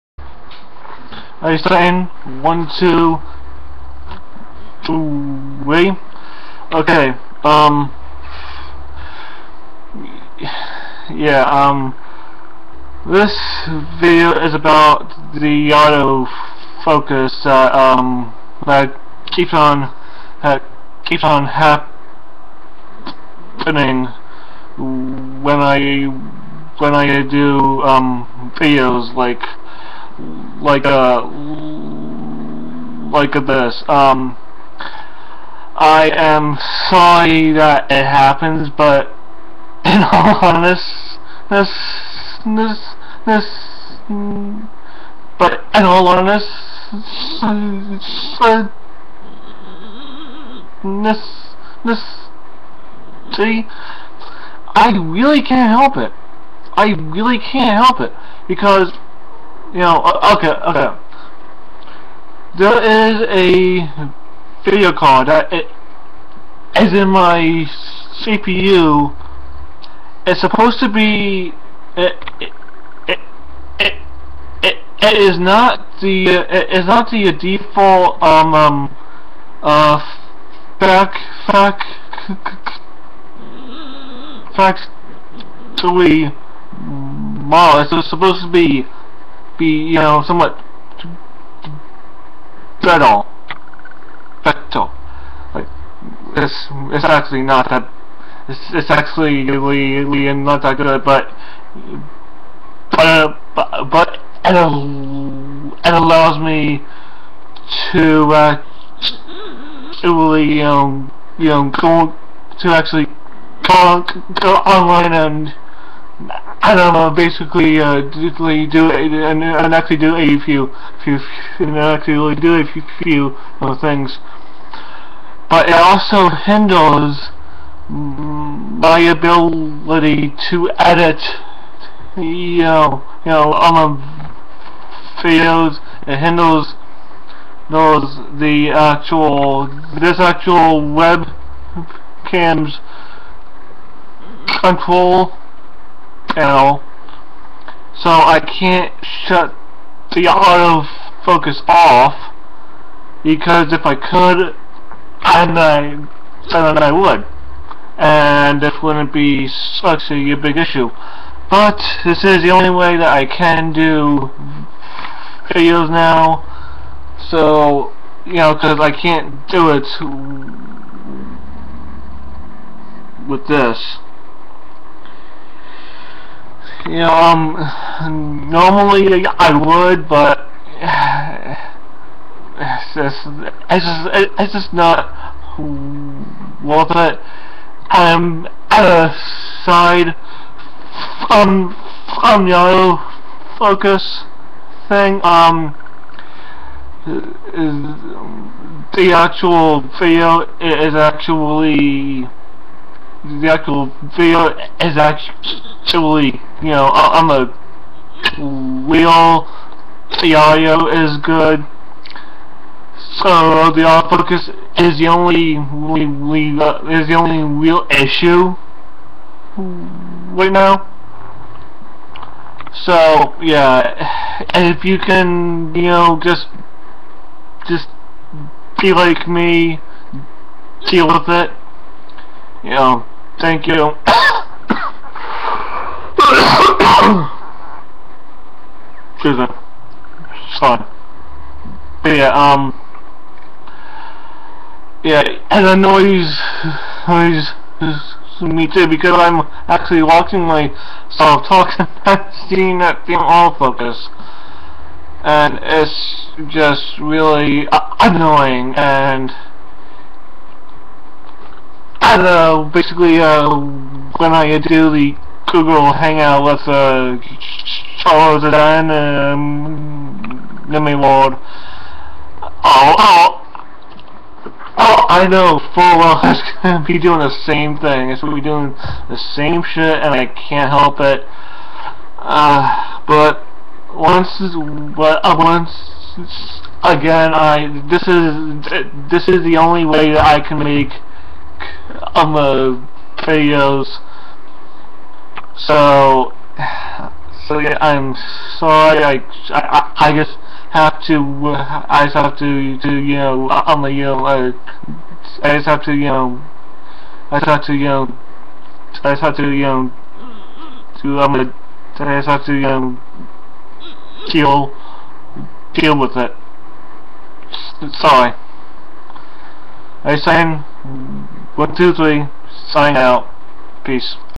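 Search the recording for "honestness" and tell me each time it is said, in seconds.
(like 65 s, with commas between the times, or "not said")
40 s, 46 s.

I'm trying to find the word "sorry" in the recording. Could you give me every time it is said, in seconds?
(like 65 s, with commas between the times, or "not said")
36 s, 240 s, 298 s, 317 s.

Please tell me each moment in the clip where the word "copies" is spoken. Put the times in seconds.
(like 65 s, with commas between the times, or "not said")
not said.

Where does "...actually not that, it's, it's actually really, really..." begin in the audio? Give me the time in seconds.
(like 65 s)
97 s.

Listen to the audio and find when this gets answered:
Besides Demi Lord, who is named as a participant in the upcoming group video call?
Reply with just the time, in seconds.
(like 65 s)
267 s.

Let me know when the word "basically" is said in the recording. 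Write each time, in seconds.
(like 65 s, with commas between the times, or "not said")
117 s, 262 s.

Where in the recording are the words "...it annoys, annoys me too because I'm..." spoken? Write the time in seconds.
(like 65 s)
245 s.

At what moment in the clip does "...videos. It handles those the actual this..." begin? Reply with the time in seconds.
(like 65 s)
135 s.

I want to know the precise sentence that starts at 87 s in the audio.
Mm, it's supposed to be be, you know, somewhat brittle.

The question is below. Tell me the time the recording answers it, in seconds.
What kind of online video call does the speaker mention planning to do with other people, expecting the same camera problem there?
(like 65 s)
265 s.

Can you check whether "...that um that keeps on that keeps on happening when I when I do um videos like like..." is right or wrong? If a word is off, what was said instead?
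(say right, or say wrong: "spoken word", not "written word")
right.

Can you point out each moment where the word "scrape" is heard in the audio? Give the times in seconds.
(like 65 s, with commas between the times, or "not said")
not said.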